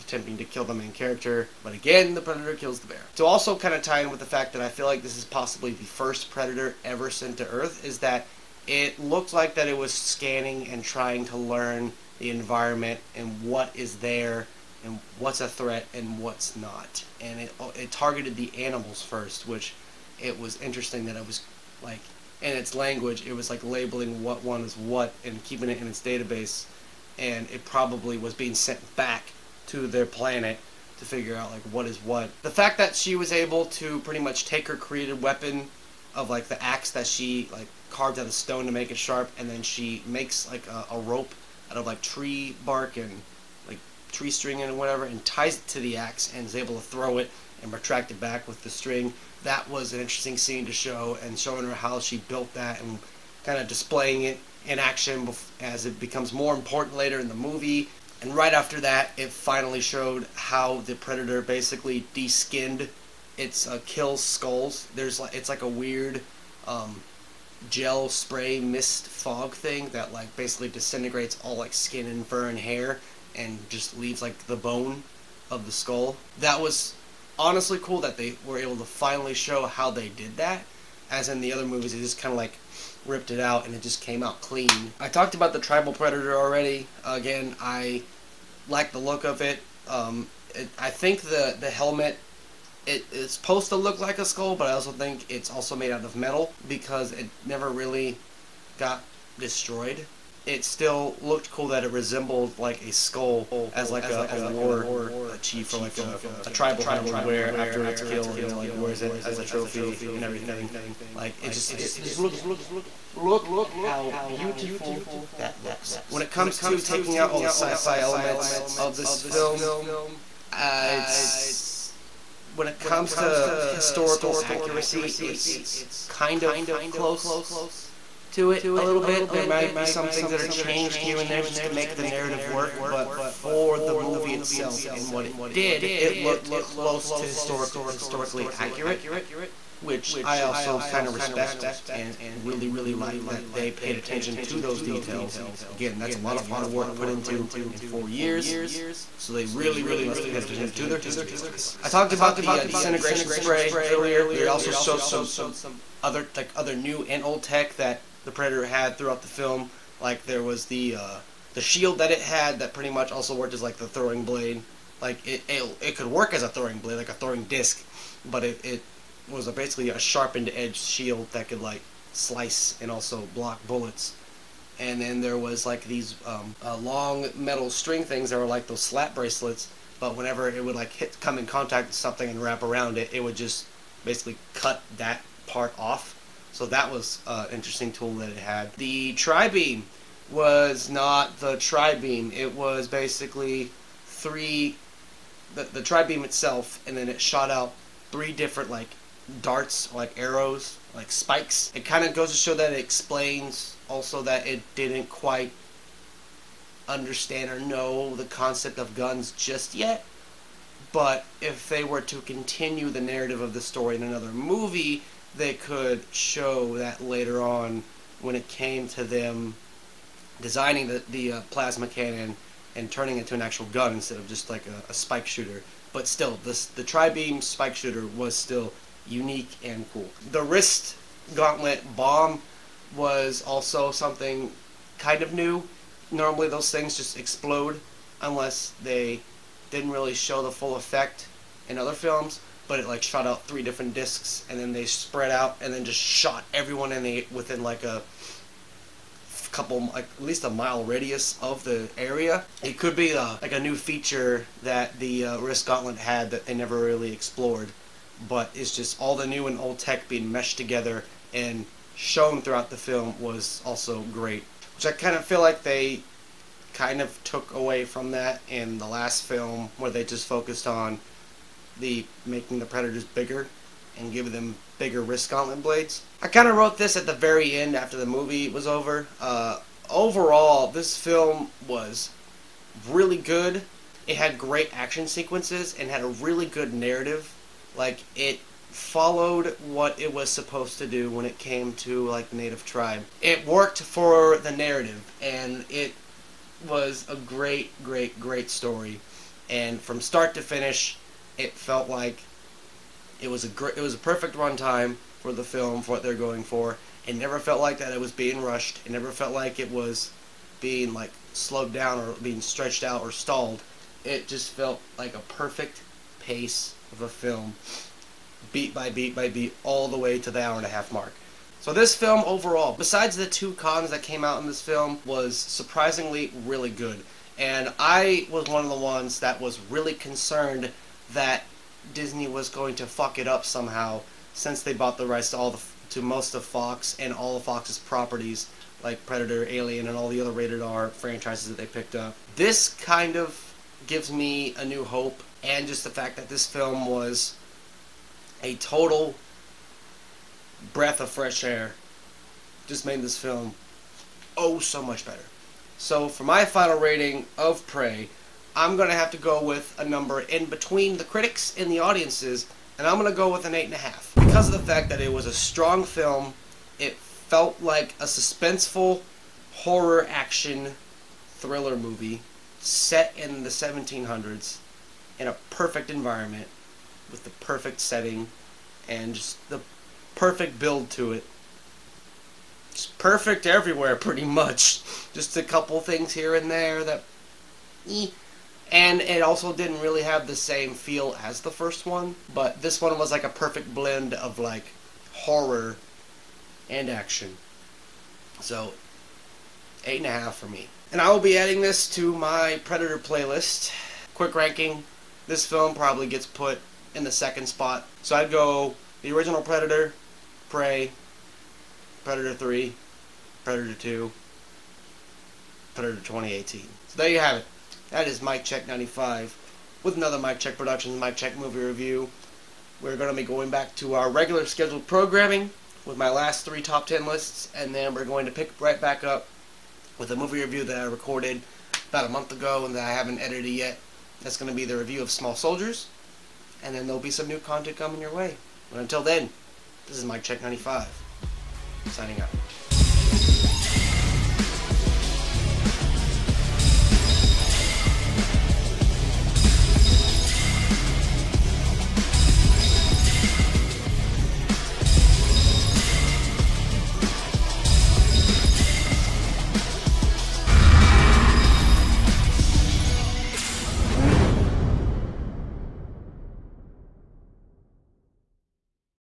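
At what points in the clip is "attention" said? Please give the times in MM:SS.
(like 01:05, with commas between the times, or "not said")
02:23, 02:30.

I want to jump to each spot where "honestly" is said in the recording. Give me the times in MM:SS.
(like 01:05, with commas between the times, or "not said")
01:17.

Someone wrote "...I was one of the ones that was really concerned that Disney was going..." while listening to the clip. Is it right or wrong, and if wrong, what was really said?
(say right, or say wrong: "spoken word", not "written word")
right.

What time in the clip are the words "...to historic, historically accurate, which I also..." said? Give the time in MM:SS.
02:17.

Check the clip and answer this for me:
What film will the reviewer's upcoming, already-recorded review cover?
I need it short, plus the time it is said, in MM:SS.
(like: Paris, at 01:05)
Small Soldiers, at 07:15.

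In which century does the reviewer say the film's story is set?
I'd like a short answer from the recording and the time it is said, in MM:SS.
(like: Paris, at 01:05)
1700s, at 06:13.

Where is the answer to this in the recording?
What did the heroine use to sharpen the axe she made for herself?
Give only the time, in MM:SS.
00:38.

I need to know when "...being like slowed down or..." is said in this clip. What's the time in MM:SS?
05:10.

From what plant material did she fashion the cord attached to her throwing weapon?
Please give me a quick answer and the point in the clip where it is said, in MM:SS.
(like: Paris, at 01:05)
Tree bark, at 00:42.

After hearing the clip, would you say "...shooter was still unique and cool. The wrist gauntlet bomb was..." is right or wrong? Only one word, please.
right.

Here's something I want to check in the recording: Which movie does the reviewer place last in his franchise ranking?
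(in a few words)
Predator 2018.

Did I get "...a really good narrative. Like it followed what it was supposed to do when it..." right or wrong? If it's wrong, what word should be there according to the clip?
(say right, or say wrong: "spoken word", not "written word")
right.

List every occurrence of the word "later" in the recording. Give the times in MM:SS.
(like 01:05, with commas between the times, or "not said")
00:56, 03:37.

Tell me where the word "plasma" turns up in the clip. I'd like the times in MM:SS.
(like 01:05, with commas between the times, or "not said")
03:41.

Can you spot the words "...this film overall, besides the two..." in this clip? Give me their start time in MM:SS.
05:21.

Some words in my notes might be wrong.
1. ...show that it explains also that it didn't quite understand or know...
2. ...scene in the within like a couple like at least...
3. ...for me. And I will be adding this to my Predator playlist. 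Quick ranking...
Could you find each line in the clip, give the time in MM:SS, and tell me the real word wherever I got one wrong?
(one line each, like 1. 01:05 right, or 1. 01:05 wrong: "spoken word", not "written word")
1. 03:22 right
2. 04:06 wrong: "everyone", not "scene"
3. 06:40 right.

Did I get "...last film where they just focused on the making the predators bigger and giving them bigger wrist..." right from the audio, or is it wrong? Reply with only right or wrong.
right.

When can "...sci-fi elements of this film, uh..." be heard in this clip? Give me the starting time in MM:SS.
01:57.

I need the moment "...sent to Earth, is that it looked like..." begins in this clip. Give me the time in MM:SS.
00:07.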